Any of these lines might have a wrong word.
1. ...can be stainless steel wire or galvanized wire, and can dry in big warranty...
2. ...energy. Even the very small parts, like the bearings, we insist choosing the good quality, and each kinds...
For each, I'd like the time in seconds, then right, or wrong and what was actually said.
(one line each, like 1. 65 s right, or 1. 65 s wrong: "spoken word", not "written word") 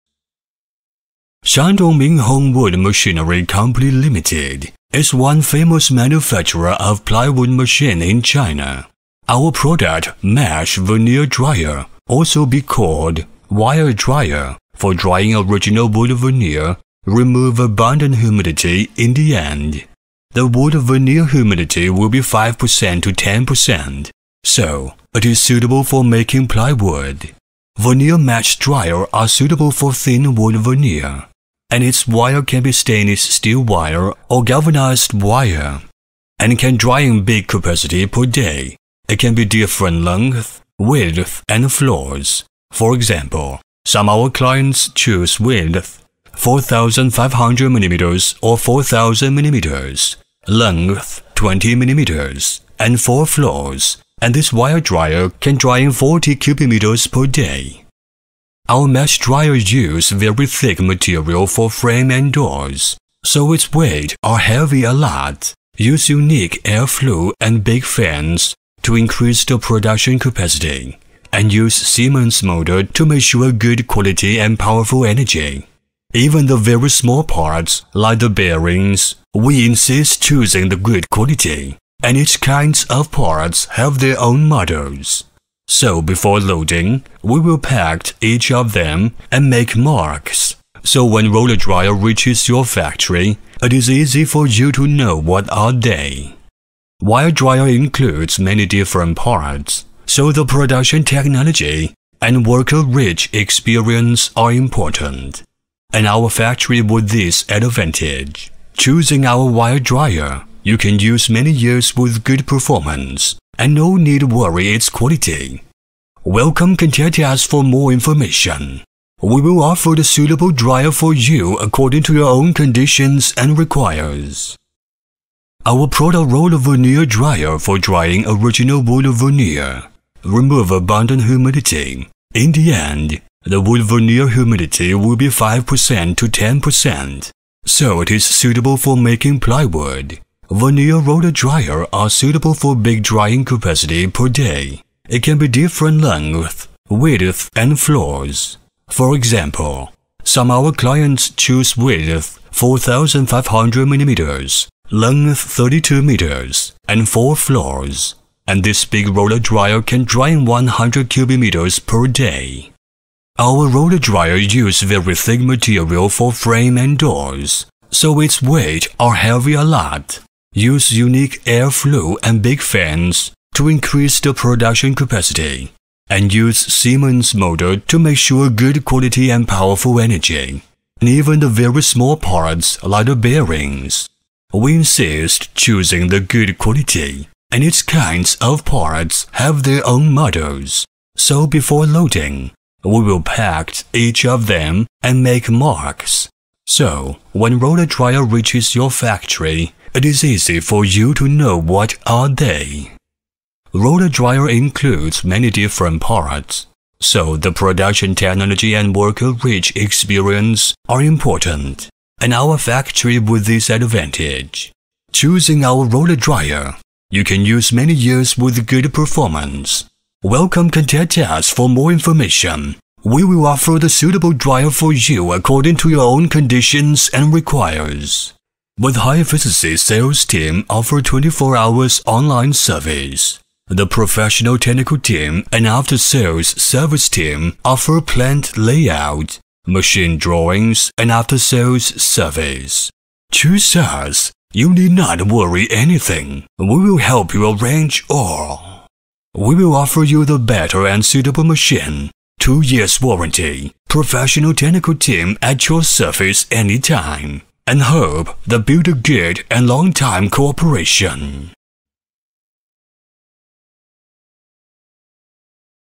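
1. 32 s wrong: "capacity", not "warranty"
2. 75 s right.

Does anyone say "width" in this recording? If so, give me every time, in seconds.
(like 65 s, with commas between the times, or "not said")
40 s, 45 s, 146 s, 151 s.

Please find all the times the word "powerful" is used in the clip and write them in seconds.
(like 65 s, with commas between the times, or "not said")
74 s, 179 s.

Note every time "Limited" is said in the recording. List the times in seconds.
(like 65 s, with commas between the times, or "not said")
3 s.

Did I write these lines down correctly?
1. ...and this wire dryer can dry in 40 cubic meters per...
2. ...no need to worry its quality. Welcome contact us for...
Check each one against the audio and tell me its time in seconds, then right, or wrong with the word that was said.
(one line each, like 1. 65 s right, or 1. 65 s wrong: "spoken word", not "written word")
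1. 54 s right
2. 113 s right.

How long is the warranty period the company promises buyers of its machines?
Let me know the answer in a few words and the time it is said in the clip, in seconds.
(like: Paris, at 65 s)
2 years, at 252 s.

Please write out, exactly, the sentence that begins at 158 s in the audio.
And this big roller dryer can dry in 100 cubic meters per day.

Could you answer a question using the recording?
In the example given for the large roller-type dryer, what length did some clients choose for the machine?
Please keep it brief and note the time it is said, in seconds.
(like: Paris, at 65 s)
32 meters, at 155 s.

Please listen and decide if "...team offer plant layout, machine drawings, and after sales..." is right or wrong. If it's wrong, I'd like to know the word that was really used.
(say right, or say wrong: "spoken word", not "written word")
right.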